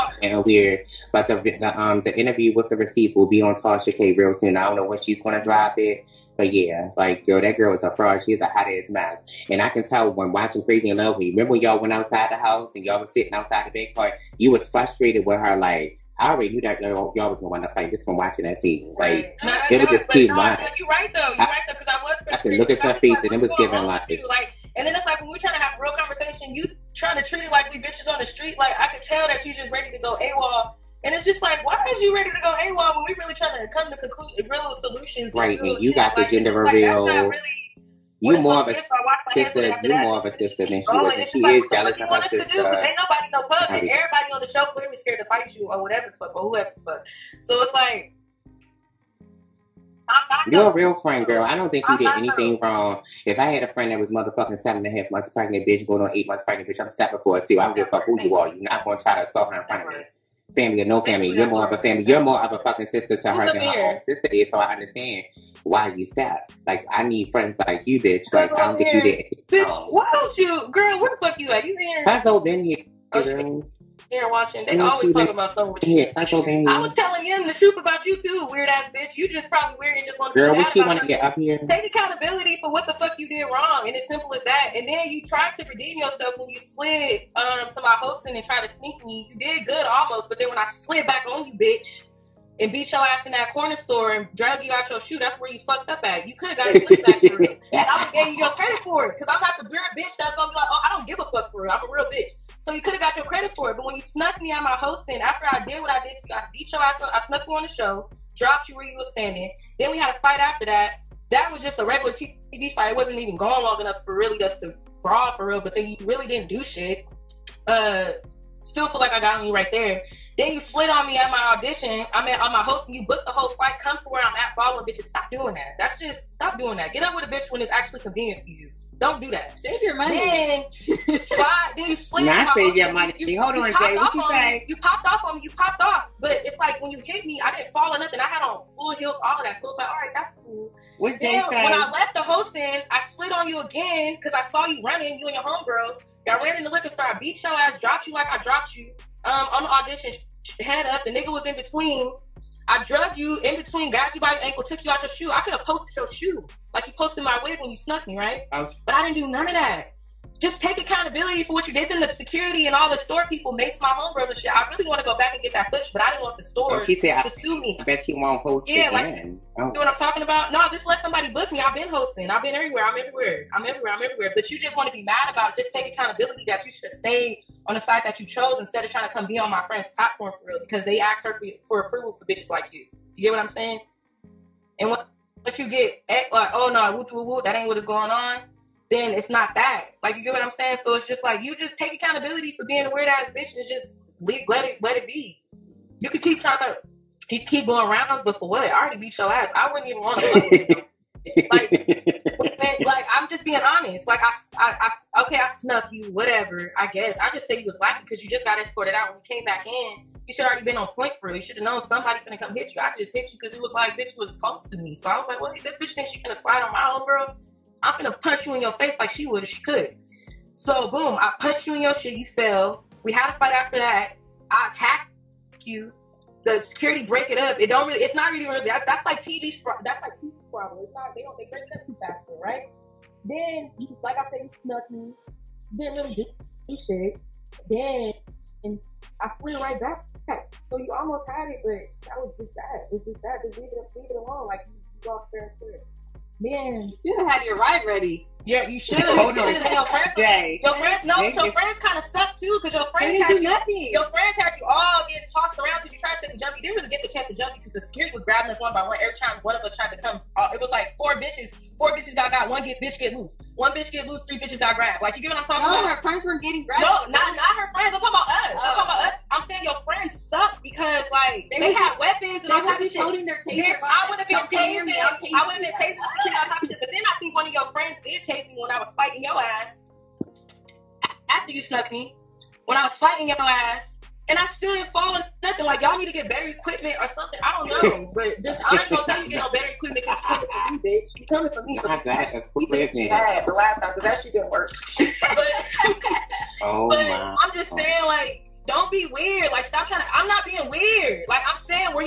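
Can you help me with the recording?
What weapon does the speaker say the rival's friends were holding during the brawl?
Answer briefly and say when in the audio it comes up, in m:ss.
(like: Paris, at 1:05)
taser, at 4:33.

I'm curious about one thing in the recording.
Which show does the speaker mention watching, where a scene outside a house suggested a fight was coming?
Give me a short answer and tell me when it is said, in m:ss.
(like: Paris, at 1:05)
Crazy in Love, at 0:10.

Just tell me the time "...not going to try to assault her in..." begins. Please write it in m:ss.
0:58.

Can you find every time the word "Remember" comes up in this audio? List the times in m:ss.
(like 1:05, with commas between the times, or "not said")
0:11.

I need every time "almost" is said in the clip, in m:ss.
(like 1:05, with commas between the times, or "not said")
1:29, 4:00.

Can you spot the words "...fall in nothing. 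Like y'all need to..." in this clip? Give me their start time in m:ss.
4:44.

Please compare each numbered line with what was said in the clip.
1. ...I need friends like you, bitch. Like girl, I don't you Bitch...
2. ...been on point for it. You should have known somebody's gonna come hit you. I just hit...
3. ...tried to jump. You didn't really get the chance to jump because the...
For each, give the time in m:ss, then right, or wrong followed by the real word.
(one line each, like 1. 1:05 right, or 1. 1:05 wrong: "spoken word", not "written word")
1. 1:06 right
2. 3:30 right
3. 4:16 right.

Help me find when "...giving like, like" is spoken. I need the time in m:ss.
0:23.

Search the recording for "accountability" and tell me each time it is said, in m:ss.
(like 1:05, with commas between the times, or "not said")
1:21, 2:40, 2:55, 3:11.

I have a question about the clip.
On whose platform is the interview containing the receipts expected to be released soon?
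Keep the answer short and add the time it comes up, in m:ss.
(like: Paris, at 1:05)
Tasha K, at 0:03.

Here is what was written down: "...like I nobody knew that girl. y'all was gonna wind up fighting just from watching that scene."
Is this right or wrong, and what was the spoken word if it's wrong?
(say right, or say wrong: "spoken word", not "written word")
wrong: "already", not "nobody".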